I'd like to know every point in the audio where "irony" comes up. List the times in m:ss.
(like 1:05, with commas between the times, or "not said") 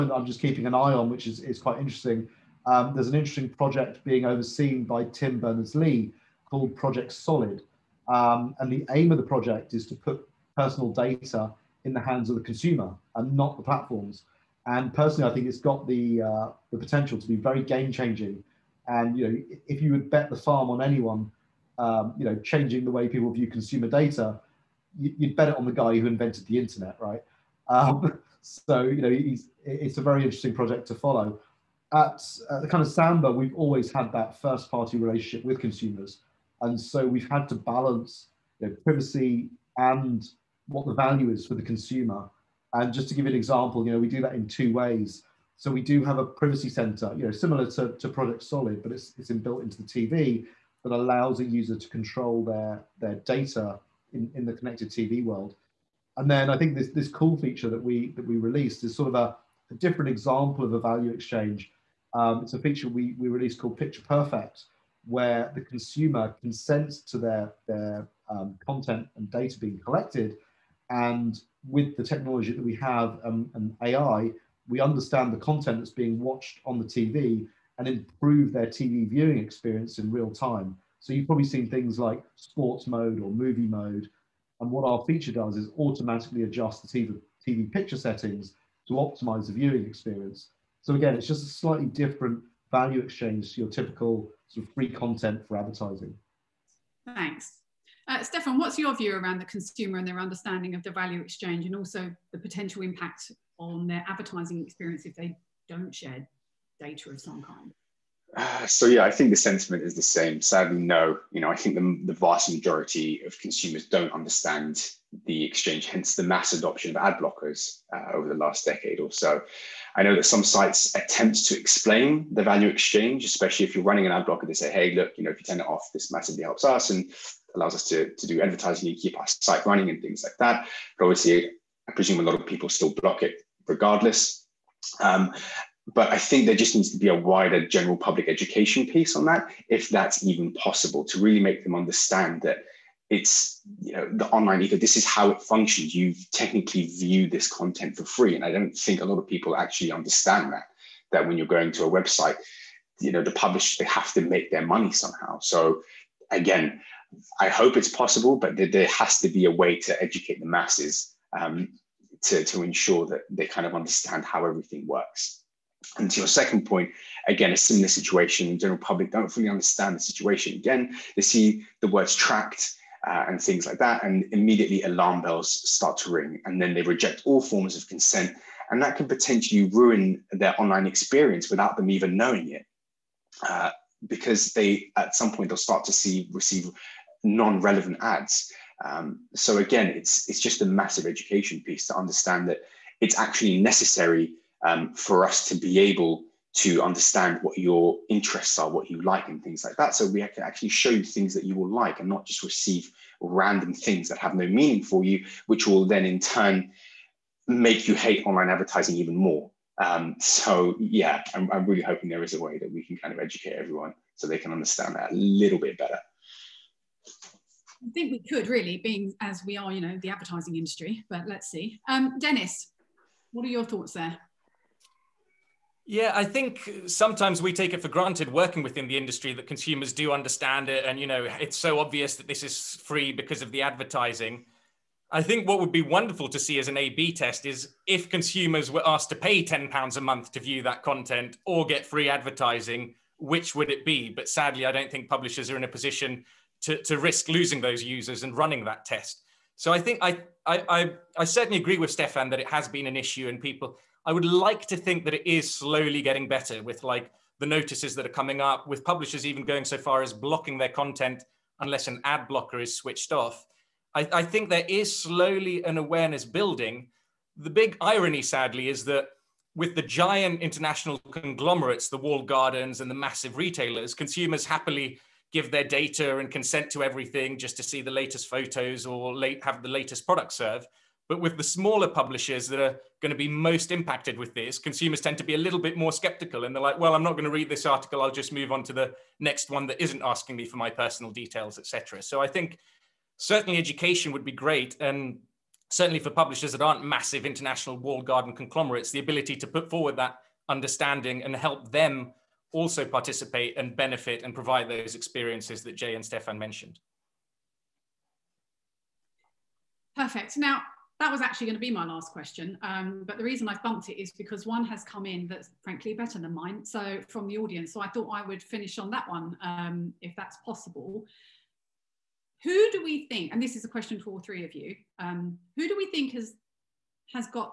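4:27.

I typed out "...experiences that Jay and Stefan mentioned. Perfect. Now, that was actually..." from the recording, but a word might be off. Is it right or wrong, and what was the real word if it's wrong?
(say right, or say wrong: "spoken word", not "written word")
right.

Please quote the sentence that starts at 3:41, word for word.
Um, Denis, what are your thoughts there?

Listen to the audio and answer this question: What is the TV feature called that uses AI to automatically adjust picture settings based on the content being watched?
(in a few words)
Picture Perfect.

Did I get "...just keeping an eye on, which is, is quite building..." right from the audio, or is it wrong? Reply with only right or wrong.
wrong.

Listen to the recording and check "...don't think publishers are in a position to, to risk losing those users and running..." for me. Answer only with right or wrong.
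right.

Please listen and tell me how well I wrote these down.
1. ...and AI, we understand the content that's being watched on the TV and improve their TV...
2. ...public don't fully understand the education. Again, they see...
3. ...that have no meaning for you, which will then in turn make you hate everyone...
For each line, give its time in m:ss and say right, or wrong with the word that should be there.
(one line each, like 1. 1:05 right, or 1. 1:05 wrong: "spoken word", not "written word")
1. 1:13 right
2. 2:48 wrong: "situation", not "education"
3. 3:24 wrong: "online", not "everyone".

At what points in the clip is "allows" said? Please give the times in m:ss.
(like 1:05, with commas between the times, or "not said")
0:50, 2:07.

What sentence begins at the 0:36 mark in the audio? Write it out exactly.
And so we've had to balance you know, privacy and what the value is for the consumer.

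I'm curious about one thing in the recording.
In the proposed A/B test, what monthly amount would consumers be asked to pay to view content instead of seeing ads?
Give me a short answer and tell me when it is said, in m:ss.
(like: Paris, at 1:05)
£10, at 3:59.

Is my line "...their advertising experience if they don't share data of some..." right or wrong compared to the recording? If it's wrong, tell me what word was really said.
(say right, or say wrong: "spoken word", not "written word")
right.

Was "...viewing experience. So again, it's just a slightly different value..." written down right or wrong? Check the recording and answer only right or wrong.
right.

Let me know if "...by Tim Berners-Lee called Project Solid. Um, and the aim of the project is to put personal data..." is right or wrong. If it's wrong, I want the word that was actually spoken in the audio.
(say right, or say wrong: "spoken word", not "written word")
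right.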